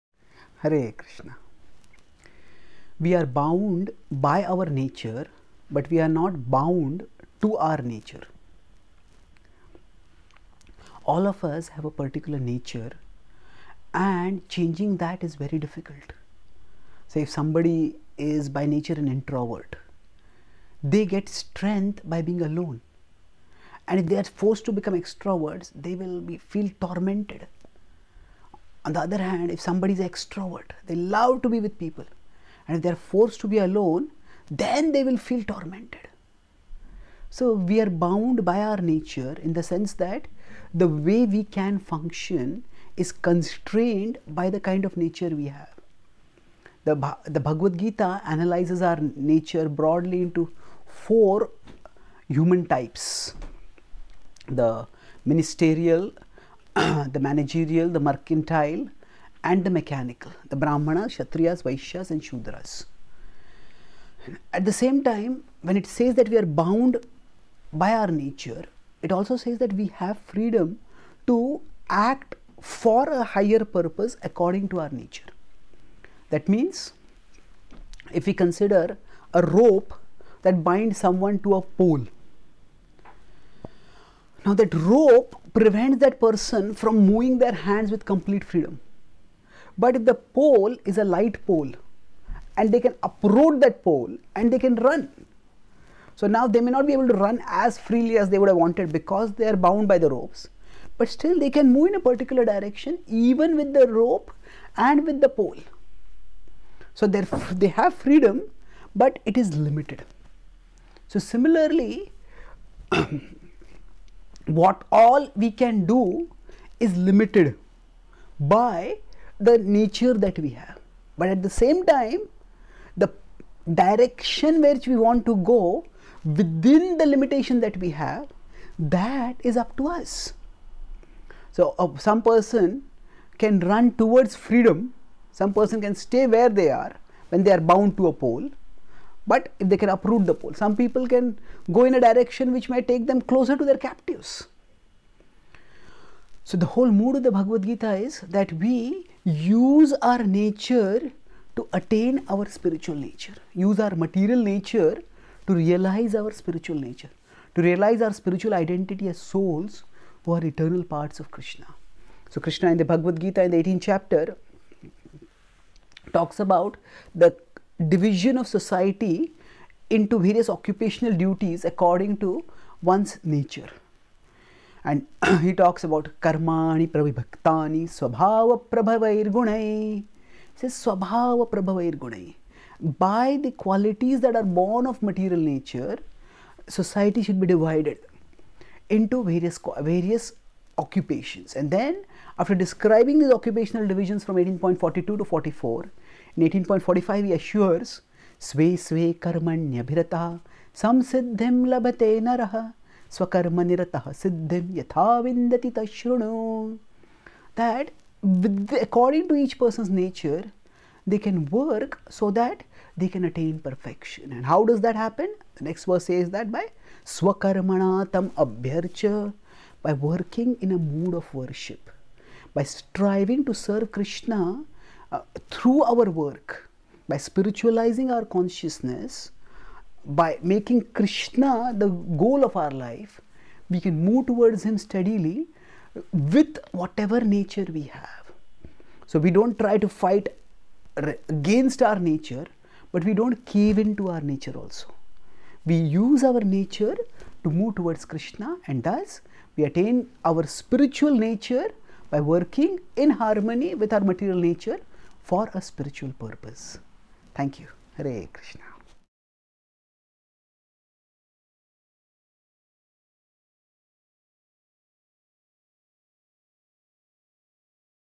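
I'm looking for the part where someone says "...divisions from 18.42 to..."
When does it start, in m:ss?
3:13.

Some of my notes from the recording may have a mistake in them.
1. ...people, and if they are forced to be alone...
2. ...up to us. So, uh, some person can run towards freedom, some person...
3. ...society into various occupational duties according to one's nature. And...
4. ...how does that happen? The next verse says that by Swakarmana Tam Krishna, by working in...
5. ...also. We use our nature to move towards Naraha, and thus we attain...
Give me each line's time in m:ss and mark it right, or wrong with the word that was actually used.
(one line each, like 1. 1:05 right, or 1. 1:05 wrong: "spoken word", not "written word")
1. 0:31 right
2. 2:09 right
3. 2:48 right
4. 3:34 wrong: "Abhyarcha", not "Krishna"
5. 4:04 wrong: "Krishna", not "Naraha".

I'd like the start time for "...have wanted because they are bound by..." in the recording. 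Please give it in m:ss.
1:38.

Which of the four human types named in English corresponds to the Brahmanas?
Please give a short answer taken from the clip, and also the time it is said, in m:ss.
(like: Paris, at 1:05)
Ministerial, at 0:54.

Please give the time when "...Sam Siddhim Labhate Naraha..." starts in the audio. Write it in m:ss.
3:20.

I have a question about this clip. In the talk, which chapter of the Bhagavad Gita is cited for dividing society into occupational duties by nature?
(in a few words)
18th chapter.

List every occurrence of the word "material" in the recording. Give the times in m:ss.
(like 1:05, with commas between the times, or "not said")
2:33, 3:05, 4:13.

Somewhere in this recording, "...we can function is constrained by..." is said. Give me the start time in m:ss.
0:41.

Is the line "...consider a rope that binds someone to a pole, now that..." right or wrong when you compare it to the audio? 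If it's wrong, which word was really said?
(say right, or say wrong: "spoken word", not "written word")
right.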